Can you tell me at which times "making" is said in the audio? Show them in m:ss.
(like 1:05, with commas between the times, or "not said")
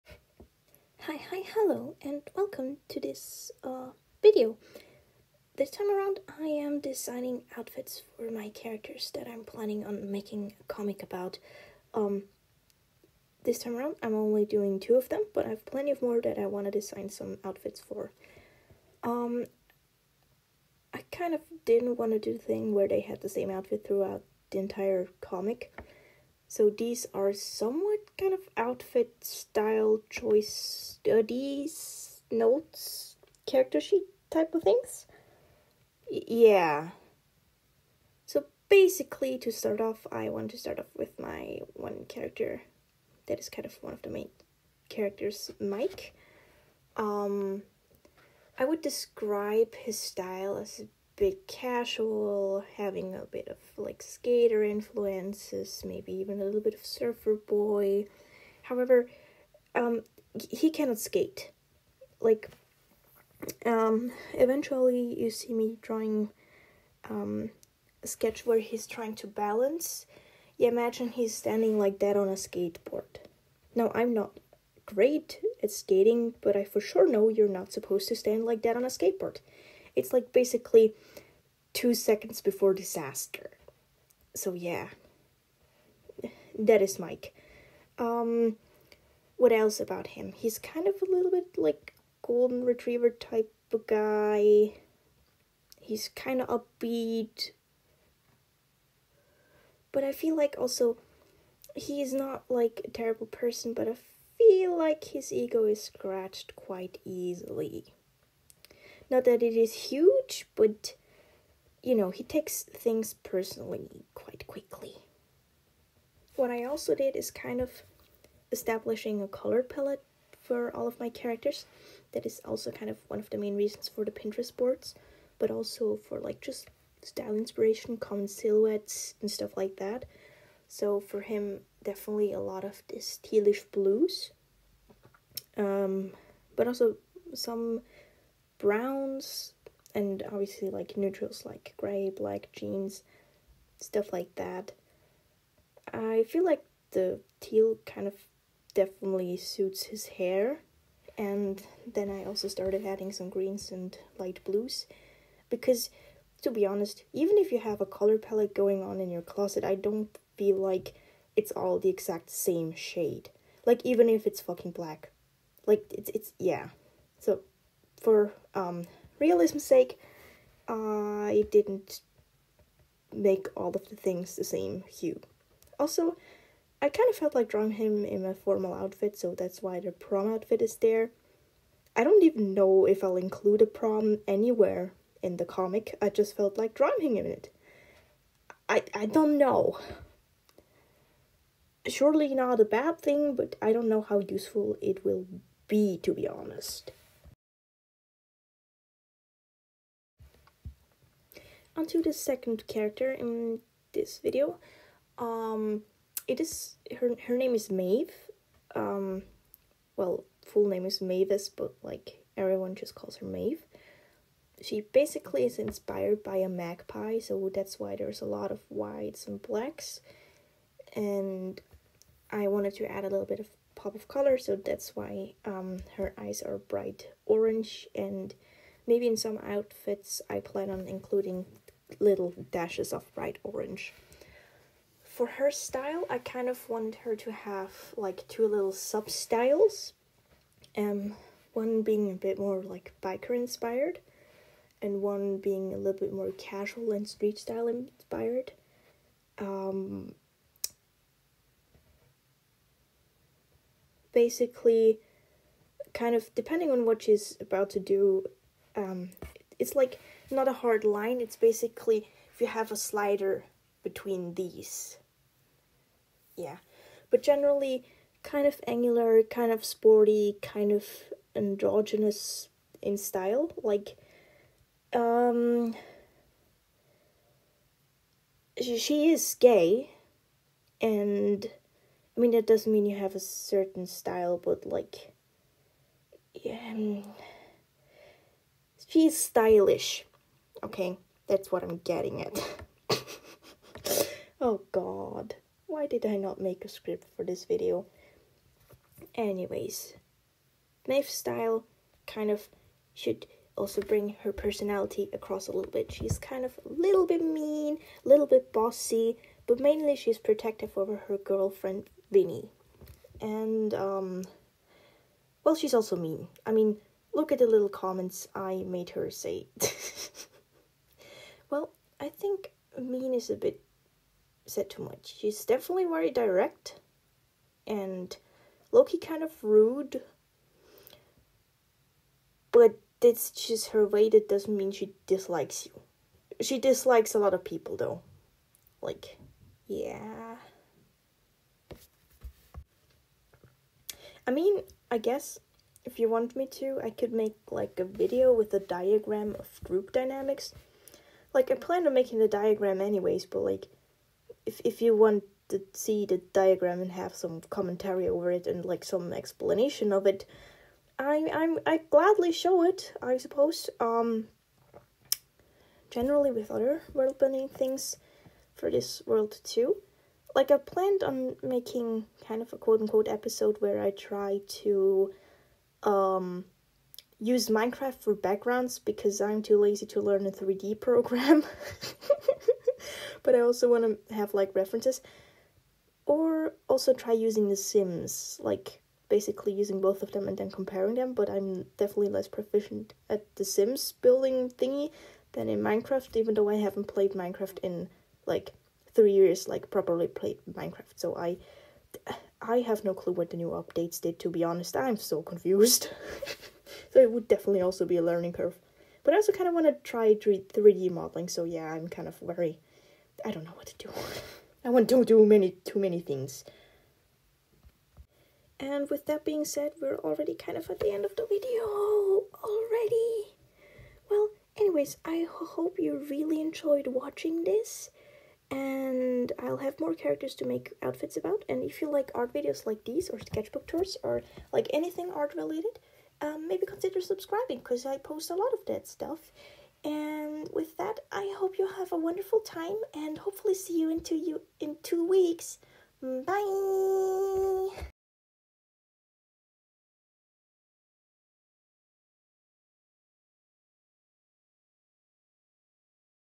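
0:10, 5:51, 6:11.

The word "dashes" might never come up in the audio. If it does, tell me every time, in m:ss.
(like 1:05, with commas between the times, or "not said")
3:52.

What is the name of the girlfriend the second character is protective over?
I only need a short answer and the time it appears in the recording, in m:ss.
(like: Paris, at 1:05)
Vinny, at 5:12.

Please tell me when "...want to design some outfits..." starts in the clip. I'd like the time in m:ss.
0:16.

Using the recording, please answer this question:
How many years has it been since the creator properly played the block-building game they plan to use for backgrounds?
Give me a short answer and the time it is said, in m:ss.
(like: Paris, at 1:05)
3, at 6:38.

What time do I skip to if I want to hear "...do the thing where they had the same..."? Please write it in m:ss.
0:22.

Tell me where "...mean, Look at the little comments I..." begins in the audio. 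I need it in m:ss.
5:16.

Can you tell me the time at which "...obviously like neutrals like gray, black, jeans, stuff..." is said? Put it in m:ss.
2:20.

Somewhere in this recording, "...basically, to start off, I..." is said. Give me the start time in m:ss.
0:38.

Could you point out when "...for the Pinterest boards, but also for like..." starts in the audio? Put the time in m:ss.
2:03.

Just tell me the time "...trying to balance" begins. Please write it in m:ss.
1:08.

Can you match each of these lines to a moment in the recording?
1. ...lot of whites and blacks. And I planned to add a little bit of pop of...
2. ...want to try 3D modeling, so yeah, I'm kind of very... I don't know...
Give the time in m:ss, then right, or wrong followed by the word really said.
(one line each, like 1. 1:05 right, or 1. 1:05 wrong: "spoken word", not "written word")
1. 3:38 wrong: "wanted", not "planned"
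2. 6:49 right.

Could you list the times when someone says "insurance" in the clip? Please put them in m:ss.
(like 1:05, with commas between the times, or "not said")
not said.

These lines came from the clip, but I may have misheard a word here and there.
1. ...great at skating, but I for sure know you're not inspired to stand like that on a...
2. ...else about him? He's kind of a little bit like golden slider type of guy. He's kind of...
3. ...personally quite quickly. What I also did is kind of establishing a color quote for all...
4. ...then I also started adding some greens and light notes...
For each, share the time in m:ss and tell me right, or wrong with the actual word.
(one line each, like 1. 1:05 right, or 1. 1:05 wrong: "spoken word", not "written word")
1. 1:14 wrong: "supposed", not "inspired"
2. 1:29 wrong: "retriever", not "slider"
3. 1:53 wrong: "palette", not "quote"
4. 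2:31 wrong: "blues", not "notes".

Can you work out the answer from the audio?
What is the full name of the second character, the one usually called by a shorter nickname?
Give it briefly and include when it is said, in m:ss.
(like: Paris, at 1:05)
Mavis, at 3:31.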